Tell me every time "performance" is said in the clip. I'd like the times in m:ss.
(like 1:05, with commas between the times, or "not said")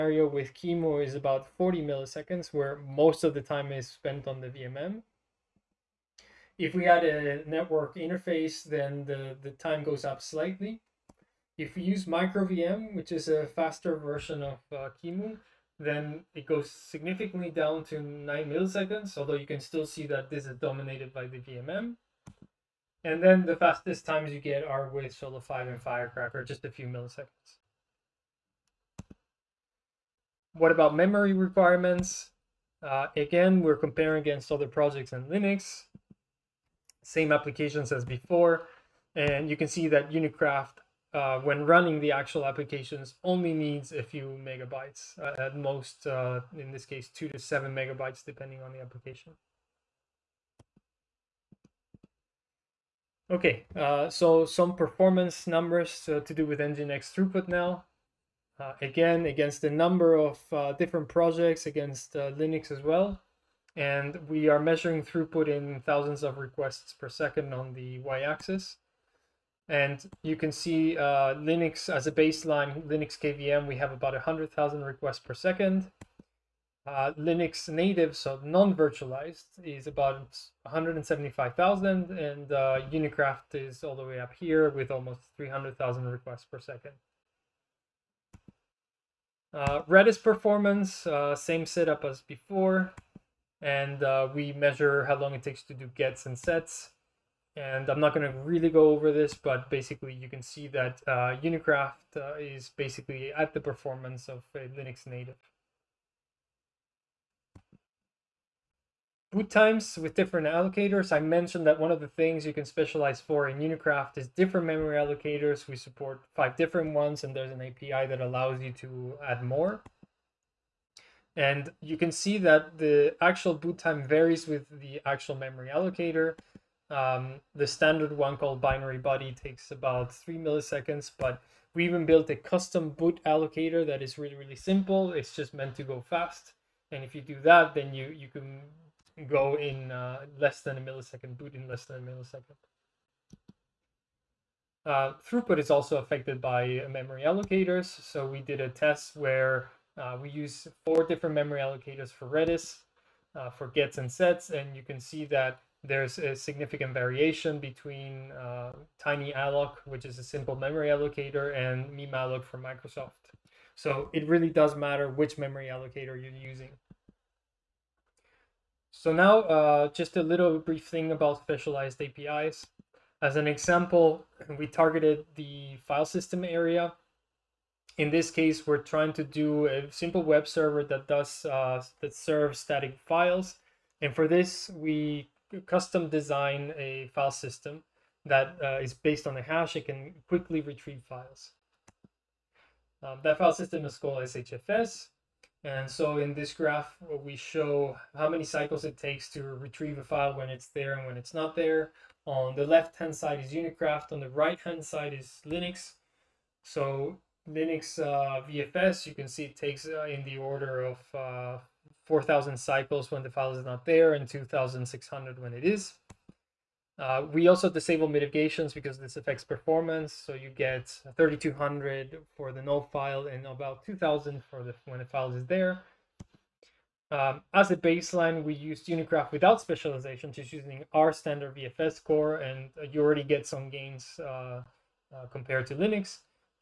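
0:54, 1:30, 1:43, 3:39.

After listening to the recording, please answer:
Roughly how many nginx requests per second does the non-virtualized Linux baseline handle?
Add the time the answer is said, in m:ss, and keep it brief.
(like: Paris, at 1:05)
175,000, at 1:20.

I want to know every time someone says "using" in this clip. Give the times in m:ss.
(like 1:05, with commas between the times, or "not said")
2:46, 3:50.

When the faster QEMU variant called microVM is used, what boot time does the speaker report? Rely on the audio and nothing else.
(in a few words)
9 milliseconds.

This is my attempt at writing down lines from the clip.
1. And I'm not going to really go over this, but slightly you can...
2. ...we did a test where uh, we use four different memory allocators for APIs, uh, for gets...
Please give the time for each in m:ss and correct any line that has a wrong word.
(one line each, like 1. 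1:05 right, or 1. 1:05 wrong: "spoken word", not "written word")
1. 1:37 wrong: "basically", not "slightly"
2. 2:28 wrong: "Redis", not "APIs".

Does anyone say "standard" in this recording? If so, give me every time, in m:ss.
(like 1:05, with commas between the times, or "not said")
2:07, 3:51.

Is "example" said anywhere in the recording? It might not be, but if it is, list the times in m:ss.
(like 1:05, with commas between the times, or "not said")
2:53.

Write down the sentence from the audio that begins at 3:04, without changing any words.
And for this, we custom design a file system that uh, is based on a hash, it can quickly retrieve files.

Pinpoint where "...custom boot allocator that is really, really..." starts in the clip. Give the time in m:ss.
2:12.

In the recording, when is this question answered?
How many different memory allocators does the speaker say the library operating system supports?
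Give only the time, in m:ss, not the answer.
1:56.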